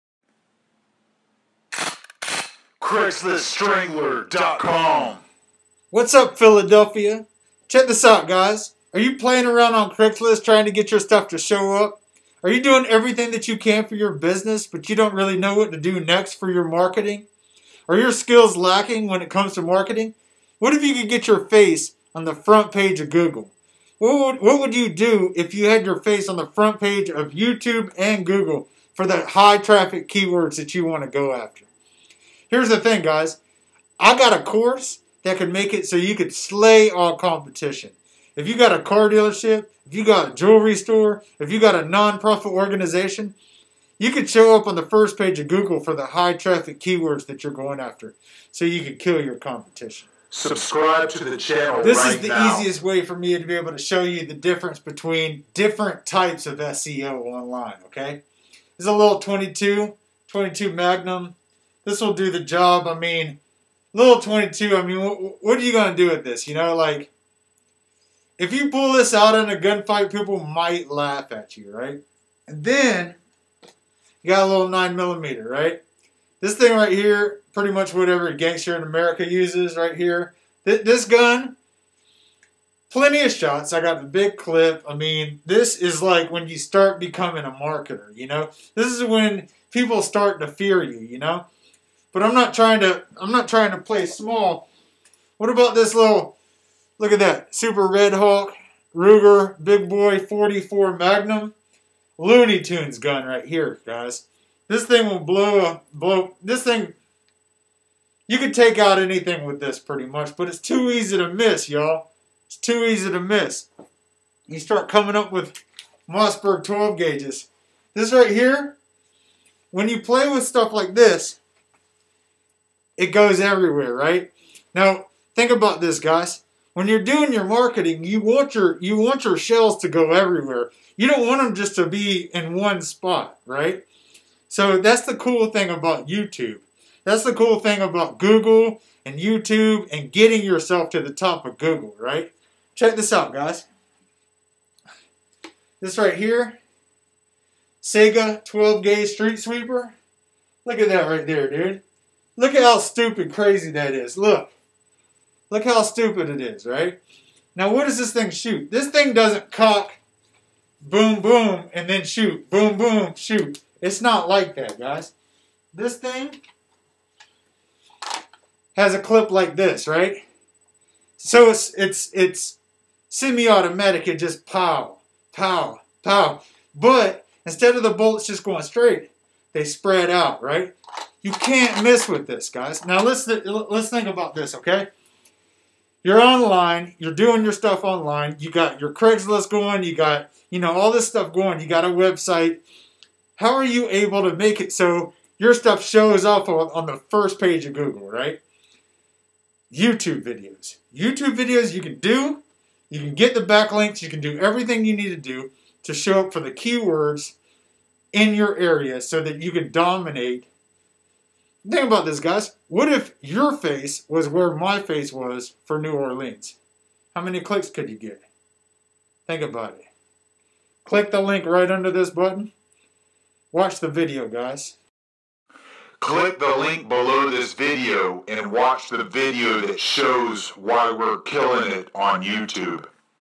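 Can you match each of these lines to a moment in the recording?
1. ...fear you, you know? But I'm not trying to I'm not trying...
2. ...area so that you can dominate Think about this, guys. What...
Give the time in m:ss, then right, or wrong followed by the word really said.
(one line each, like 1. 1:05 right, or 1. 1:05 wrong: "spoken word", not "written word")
1. 1:30 right
2. 3:28 right.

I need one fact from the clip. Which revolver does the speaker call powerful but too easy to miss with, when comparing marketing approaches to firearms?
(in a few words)
Super Redhawk Ruger.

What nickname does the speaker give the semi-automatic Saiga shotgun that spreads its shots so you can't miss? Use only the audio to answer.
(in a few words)
street sweeper.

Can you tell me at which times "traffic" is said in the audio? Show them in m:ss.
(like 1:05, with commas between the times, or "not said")
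0:29, 0:46.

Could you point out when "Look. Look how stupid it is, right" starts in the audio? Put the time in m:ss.
2:34.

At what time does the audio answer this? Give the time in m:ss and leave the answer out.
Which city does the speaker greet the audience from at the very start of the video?
0:06.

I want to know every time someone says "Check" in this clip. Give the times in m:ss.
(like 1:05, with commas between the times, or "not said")
0:07, 2:22.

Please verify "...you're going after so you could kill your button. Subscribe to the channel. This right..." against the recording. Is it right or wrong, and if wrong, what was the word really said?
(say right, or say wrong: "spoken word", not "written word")
wrong: "competition", not "button".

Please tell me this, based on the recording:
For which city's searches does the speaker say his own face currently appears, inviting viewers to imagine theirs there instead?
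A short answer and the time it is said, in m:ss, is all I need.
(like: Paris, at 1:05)
New Orleans, at 3:35.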